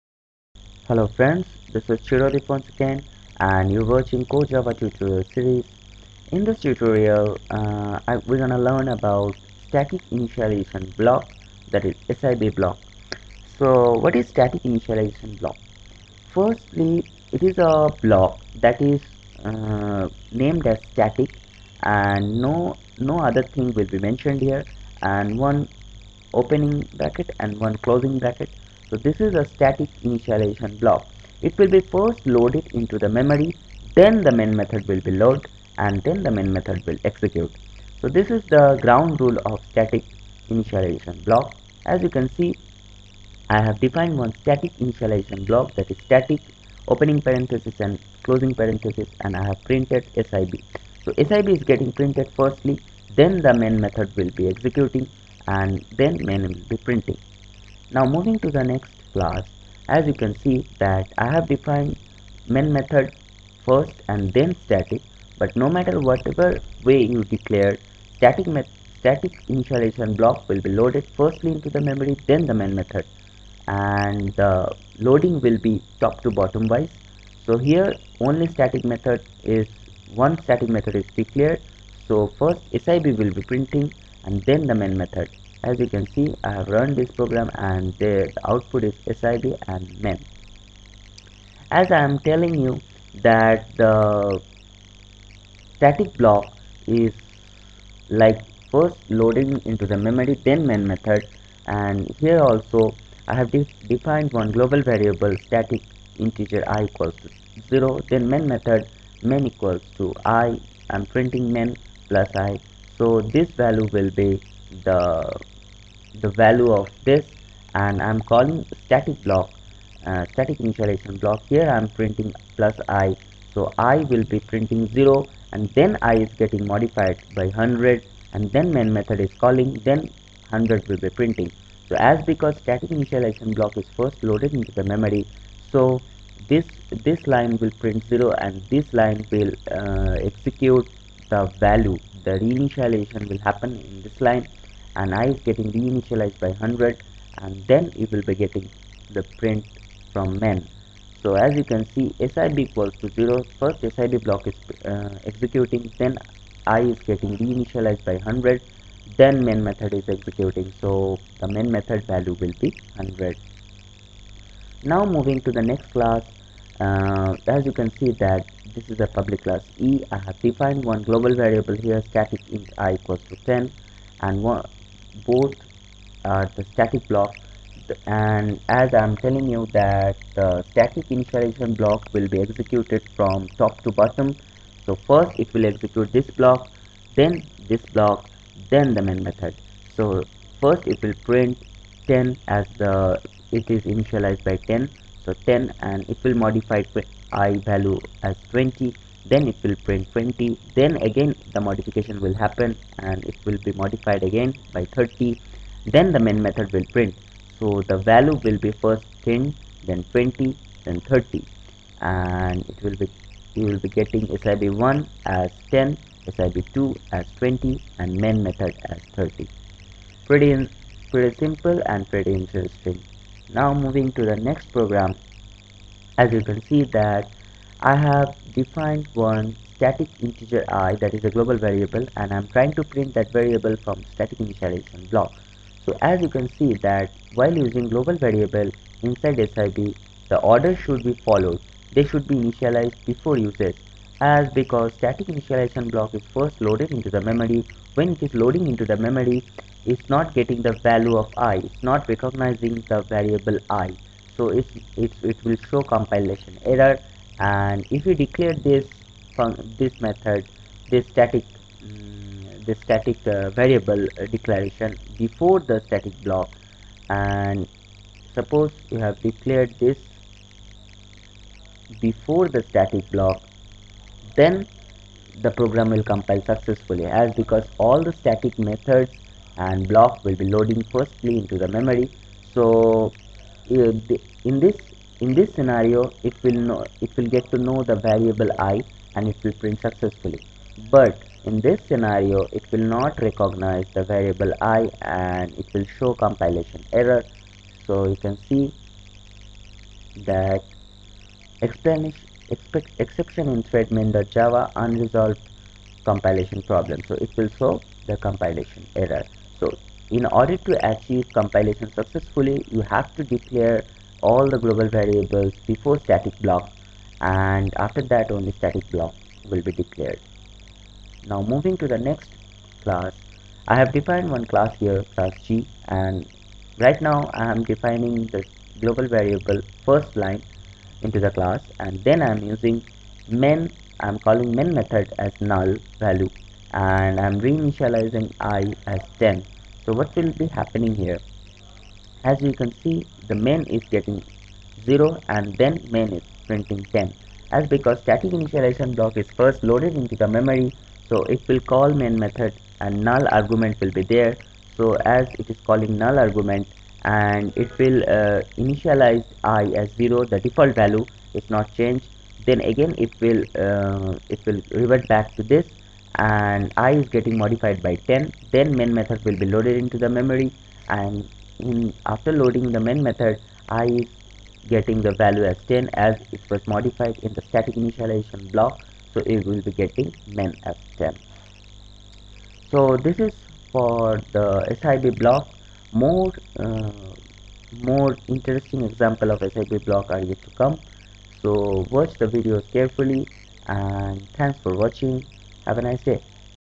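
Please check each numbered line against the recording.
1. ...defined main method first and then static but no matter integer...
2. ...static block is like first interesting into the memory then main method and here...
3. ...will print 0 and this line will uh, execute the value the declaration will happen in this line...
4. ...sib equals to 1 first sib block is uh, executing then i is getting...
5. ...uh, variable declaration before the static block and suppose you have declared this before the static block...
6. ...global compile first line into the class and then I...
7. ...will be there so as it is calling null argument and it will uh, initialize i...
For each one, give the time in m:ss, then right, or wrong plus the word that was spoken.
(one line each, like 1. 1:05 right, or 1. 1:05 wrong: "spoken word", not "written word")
1. 1:01 wrong: "whatever", not "integer"
2. 1:35 wrong: "loading", not "interesting"
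3. 2:17 wrong: "reinitialization", not "declaration"
4. 2:32 wrong: "0", not "1"
5. 4:23 right
6. 5:28 wrong: "variable", not "compile"
7. 5:53 right.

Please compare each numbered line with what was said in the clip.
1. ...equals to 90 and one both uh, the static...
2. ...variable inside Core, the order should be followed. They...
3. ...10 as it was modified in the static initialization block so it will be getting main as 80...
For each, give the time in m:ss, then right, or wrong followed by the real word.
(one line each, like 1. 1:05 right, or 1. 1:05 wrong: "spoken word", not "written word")
1. 2:52 wrong: "10", not "90"
2. 3:58 wrong: "SIB", not "Core"
3. 6:15 wrong: "10", not "80".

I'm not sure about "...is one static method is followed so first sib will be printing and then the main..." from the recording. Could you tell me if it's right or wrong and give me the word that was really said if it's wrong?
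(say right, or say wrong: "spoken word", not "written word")
wrong: "declared", not "followed".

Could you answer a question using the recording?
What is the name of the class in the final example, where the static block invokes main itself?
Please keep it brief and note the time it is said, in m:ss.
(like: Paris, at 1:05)
G, at 5:25.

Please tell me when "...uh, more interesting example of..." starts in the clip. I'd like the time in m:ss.
6:26.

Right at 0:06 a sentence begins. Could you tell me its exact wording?
In this tutorial, uh, I, we're gonna learn about static initialization block that is SIB block.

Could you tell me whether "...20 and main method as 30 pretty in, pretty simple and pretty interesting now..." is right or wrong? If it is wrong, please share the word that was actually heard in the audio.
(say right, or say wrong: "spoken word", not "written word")
right.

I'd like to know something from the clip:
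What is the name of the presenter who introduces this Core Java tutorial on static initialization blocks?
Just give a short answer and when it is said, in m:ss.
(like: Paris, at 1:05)
Chirodip, at 0:02.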